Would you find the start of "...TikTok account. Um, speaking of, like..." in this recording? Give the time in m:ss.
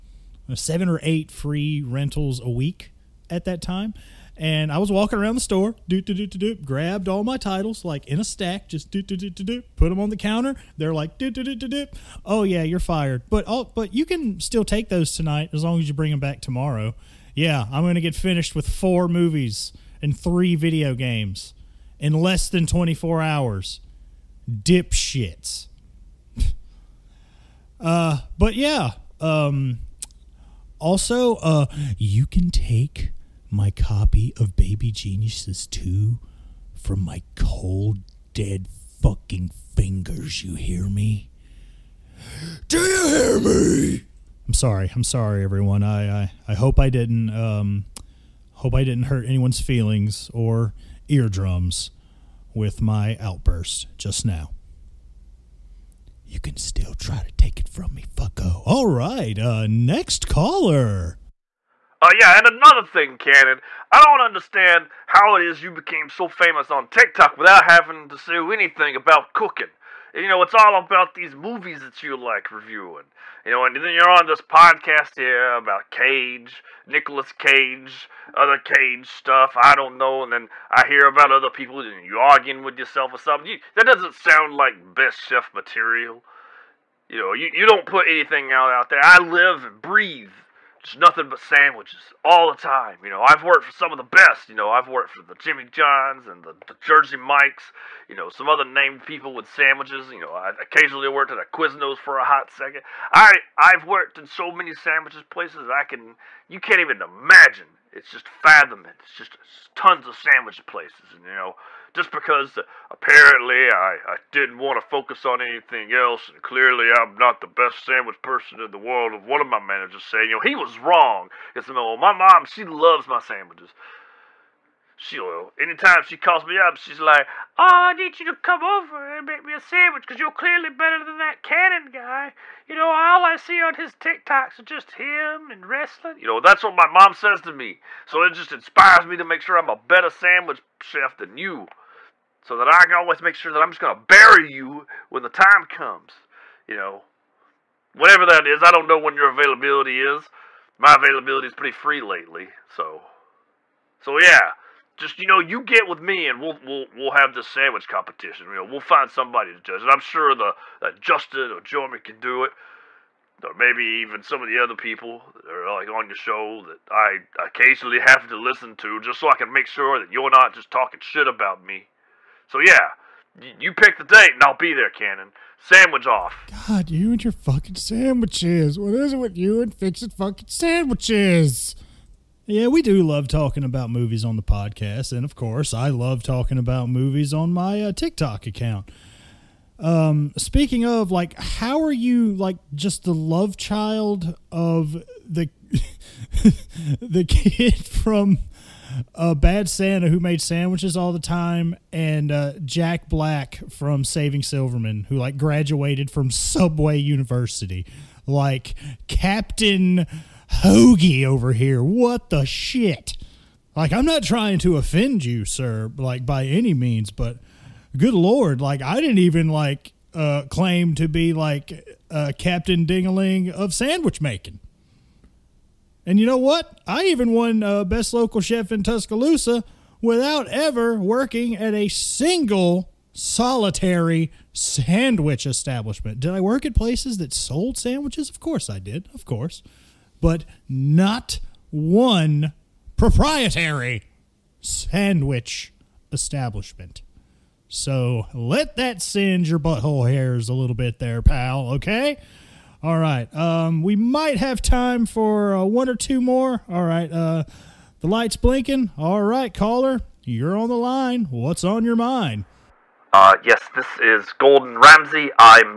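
3:07.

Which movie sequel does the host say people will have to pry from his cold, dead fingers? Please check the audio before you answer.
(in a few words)
Baby Geniuses 2.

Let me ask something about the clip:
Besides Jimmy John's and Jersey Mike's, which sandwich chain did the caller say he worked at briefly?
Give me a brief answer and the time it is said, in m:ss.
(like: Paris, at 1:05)
Quiznos, at 1:41.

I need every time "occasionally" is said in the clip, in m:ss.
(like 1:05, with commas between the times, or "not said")
1:40, 2:47.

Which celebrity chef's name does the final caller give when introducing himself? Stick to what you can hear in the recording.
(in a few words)
Gordon Ramsay.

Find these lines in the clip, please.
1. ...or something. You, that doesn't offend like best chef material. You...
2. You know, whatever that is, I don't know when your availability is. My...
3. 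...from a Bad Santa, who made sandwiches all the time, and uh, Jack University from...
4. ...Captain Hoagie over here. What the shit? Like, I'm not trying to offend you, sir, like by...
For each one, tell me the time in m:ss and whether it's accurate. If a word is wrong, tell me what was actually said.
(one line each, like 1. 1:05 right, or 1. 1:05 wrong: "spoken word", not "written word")
1. 1:23 wrong: "sound", not "offend"
2. 2:26 right
3. 3:17 wrong: "Black", not "University"
4. 3:29 right.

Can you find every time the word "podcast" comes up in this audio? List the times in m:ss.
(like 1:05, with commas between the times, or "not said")
1:14, 3:04.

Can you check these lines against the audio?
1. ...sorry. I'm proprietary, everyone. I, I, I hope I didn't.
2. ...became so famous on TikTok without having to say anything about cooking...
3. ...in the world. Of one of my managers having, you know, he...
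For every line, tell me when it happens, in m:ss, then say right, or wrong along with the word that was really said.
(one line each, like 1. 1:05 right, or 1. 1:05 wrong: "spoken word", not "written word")
1. 0:44 wrong: "sorry", not "proprietary"
2. 1:05 right
3. 1:58 wrong: "saying", not "having".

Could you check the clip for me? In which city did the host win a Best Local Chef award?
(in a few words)
Tuscaloosa.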